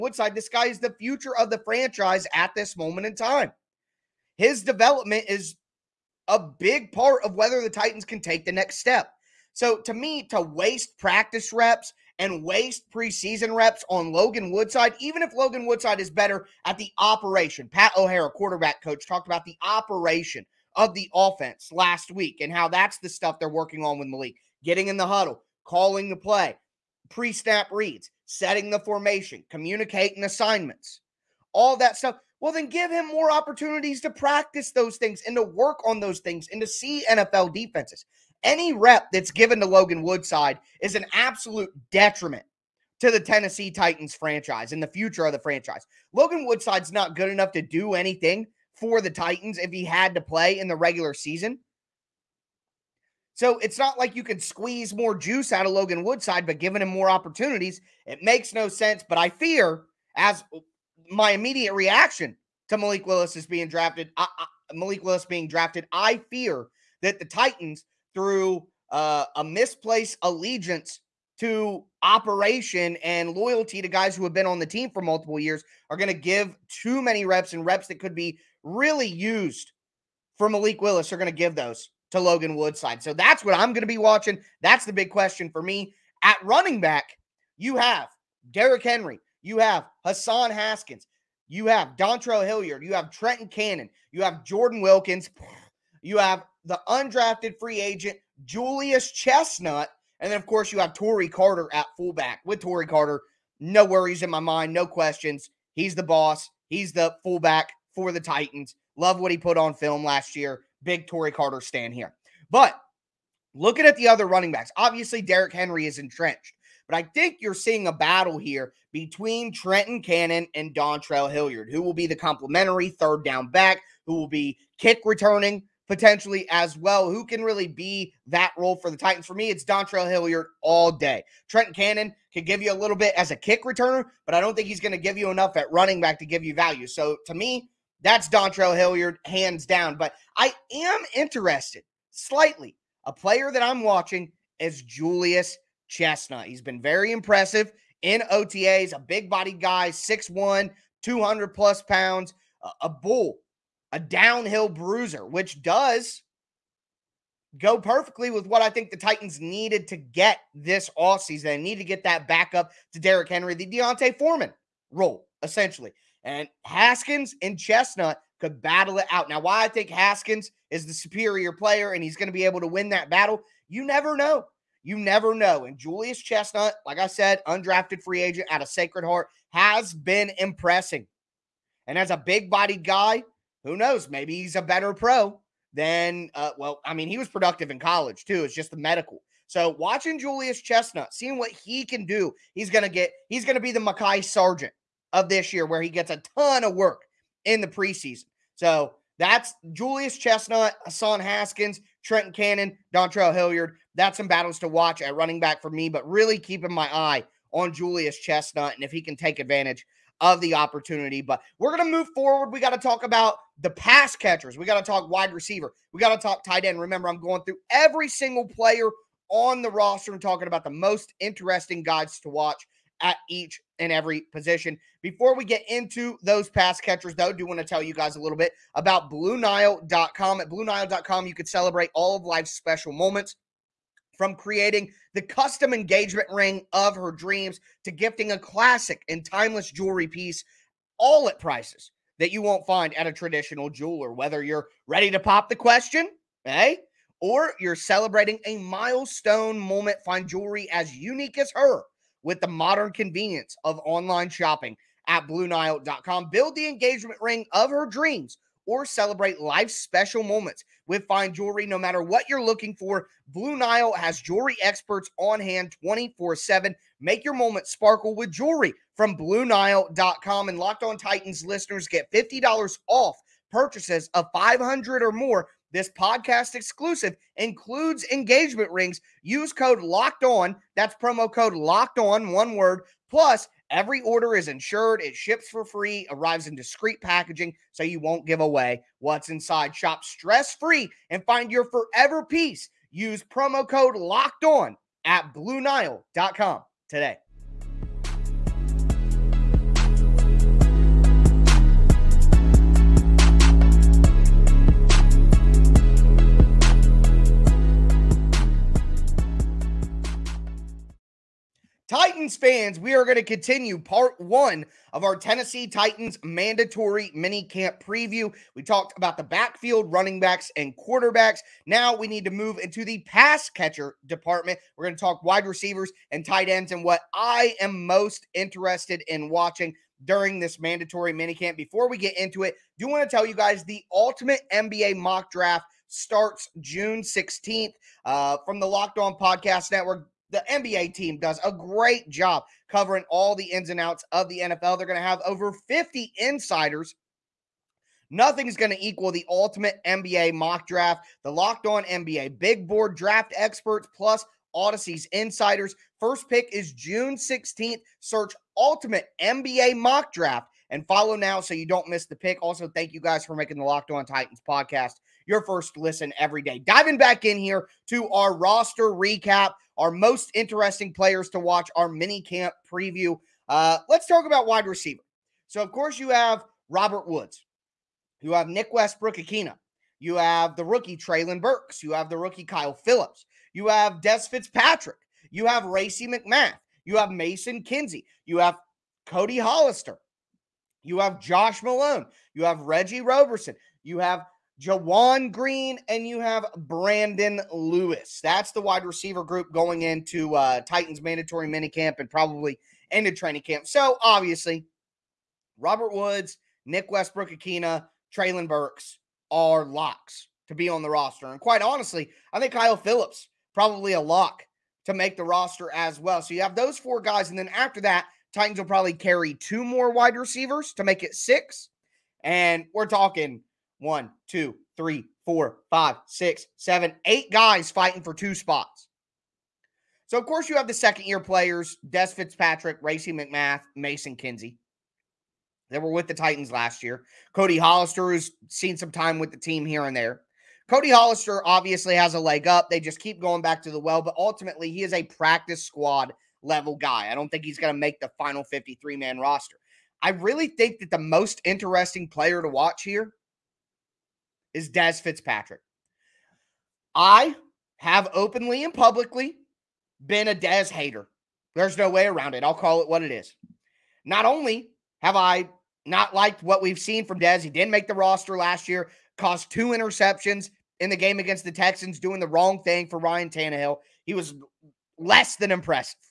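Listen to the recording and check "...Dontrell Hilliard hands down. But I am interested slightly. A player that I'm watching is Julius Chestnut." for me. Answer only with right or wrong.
right.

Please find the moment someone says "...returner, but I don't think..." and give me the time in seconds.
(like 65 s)
133 s.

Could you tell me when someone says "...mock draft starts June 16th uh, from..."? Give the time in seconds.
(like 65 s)
334 s.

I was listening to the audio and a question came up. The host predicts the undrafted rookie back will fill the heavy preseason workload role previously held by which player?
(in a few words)
Mekhi Sargent.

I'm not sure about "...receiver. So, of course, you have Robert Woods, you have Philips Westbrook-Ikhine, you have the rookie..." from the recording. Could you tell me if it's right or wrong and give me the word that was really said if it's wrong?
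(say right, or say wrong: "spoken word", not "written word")
wrong: "Nick", not "Philips".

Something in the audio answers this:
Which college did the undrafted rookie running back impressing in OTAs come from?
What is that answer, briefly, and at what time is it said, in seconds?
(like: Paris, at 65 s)
Sacred Heart, at 178 s.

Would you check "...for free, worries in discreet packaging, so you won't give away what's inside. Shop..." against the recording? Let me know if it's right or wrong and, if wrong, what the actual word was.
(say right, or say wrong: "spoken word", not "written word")
wrong: "arrives", not "worries".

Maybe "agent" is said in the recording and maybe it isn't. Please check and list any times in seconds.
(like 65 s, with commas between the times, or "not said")
97 s, 178 s.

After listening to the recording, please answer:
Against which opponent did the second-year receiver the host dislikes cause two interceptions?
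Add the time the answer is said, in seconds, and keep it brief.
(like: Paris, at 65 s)
Texans, at 471 s.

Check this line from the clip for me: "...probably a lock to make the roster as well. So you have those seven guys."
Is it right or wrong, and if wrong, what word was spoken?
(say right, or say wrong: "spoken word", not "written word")
wrong: "four", not "seven".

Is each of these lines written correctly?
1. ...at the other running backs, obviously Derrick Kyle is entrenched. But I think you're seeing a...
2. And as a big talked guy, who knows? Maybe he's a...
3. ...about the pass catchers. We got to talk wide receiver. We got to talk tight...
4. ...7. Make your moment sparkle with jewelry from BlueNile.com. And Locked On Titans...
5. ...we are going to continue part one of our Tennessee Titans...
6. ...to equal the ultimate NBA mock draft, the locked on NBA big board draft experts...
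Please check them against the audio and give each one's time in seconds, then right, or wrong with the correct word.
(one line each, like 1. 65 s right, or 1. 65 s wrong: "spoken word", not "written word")
1. 113 s wrong: "Henry", not "Kyle"
2. 181 s wrong: "bodied", not "talked"
3. 213 s right
4. 266 s right
5. 312 s right
6. 348 s right.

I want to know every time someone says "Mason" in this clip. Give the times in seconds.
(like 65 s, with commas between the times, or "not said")
387 s, 433 s.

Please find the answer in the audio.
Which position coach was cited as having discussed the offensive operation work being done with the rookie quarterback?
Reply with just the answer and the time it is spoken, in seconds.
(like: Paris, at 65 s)
Pat O'Hara, at 17 s.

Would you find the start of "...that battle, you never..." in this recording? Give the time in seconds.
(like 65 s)
172 s.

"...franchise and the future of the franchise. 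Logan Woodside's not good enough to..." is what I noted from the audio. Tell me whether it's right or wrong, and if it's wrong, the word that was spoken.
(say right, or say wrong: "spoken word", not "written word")
right.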